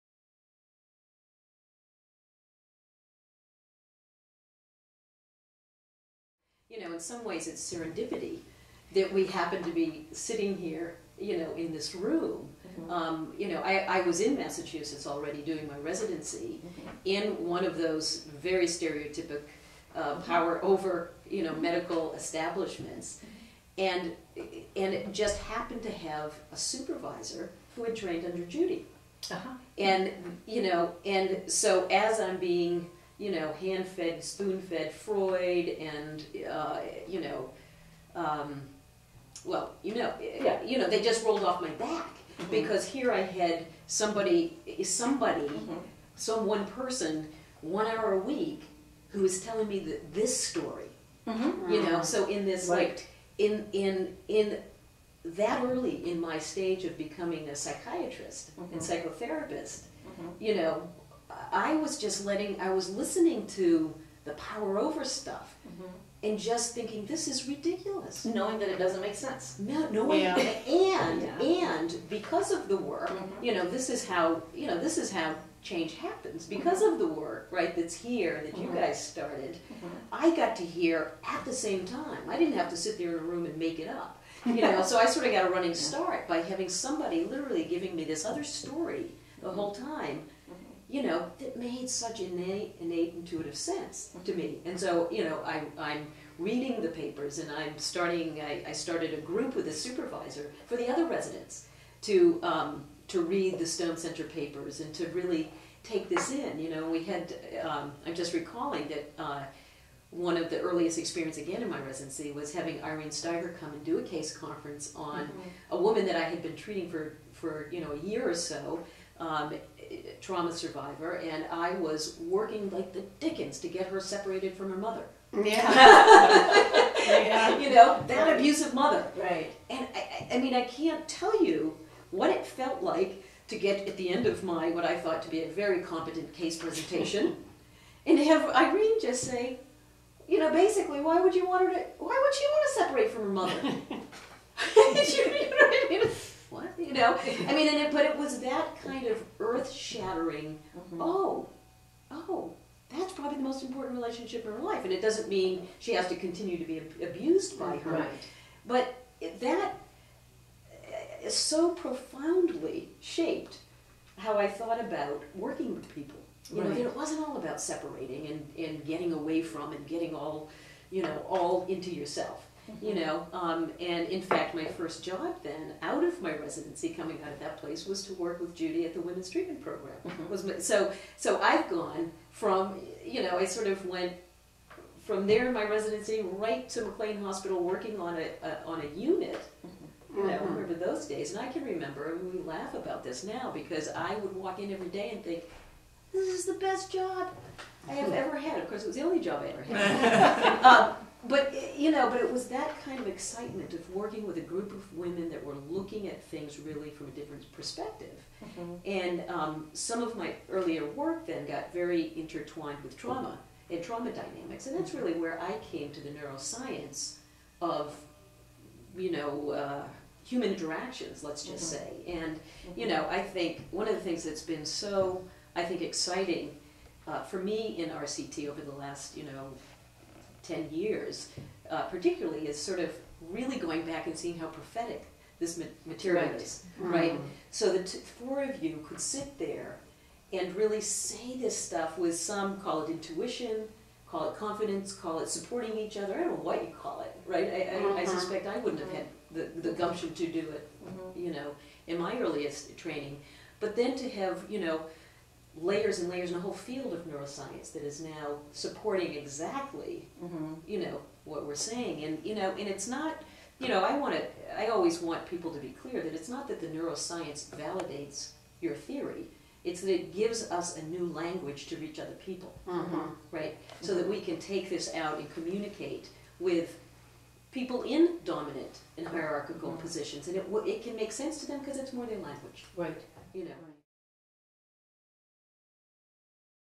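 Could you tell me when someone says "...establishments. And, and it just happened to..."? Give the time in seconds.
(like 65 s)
22 s.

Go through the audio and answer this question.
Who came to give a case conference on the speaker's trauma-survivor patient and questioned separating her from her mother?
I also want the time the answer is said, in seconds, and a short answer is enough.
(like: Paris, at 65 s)
Irene Stiver, at 112 s.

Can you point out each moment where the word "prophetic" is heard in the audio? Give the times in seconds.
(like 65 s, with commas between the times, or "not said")
234 s.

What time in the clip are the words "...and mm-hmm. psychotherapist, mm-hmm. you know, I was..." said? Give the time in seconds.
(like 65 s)
58 s.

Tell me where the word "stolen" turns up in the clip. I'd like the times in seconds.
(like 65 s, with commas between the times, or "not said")
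not said.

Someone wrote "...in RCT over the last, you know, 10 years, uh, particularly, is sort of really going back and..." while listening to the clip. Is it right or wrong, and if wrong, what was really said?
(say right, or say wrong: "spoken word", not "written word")
right.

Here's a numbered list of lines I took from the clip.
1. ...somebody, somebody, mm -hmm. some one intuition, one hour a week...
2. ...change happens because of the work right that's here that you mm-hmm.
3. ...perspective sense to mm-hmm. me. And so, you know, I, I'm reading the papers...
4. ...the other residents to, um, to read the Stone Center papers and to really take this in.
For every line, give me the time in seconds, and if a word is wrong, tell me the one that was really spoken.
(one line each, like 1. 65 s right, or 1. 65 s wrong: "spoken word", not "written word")
1. 43 s wrong: "person", not "intuition"
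2. 75 s right
3. 93 s wrong: "intuitive", not "perspective"
4. 100 s right.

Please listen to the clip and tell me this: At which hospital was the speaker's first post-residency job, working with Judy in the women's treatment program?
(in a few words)
McLean Hospital.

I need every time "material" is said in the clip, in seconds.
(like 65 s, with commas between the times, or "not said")
235 s.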